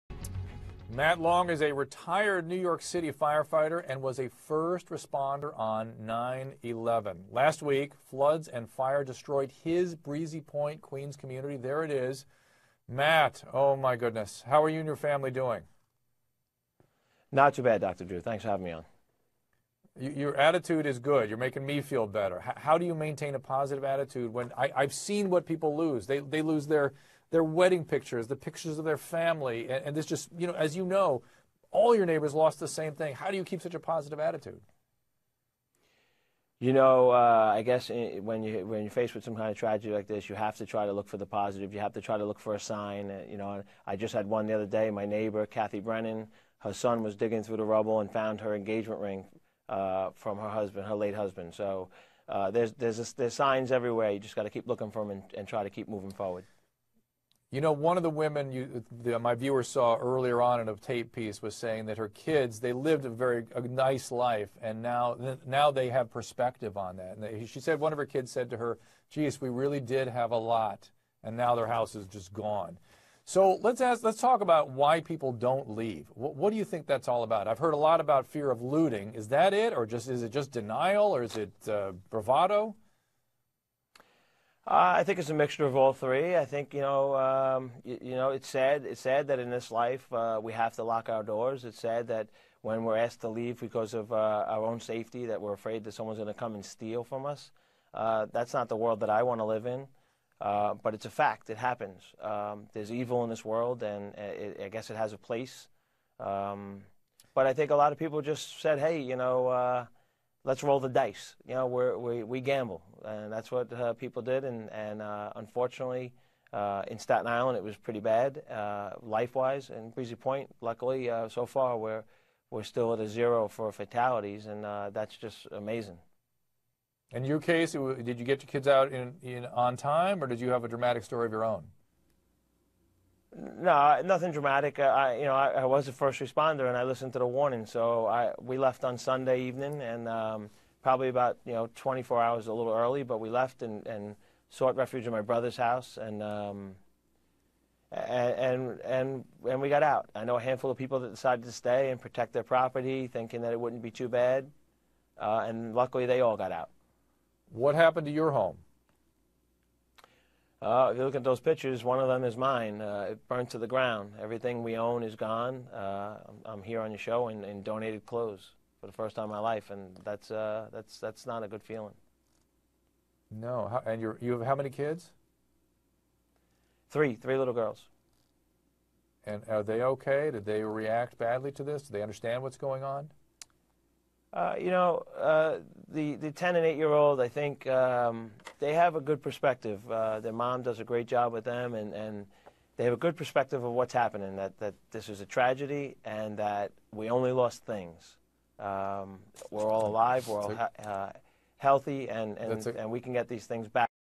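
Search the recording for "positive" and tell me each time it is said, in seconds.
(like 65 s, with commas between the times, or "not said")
23 s, 33 s, 41 s.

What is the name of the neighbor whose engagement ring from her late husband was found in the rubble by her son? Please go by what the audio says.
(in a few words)
Kathy Brennan.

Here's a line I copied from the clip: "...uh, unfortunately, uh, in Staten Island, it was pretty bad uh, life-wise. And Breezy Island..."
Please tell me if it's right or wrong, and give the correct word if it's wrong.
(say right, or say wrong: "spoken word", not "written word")
wrong: "Point", not "Island".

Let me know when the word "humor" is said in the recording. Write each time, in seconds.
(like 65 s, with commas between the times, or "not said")
not said.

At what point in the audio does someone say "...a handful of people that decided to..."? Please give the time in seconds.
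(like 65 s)
150 s.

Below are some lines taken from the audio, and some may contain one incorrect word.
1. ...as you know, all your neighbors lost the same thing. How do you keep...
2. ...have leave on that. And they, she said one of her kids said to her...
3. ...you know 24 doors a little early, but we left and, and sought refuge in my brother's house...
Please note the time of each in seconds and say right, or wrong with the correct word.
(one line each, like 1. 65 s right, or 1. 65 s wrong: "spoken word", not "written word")
1. 30 s right
2. 65 s wrong: "perspective", not "leave"
3. 141 s wrong: "hours", not "doors".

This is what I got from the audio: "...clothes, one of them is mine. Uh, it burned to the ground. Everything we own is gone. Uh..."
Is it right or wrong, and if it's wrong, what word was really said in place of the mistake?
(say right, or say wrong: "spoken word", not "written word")
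wrong: "pictures", not "clothes".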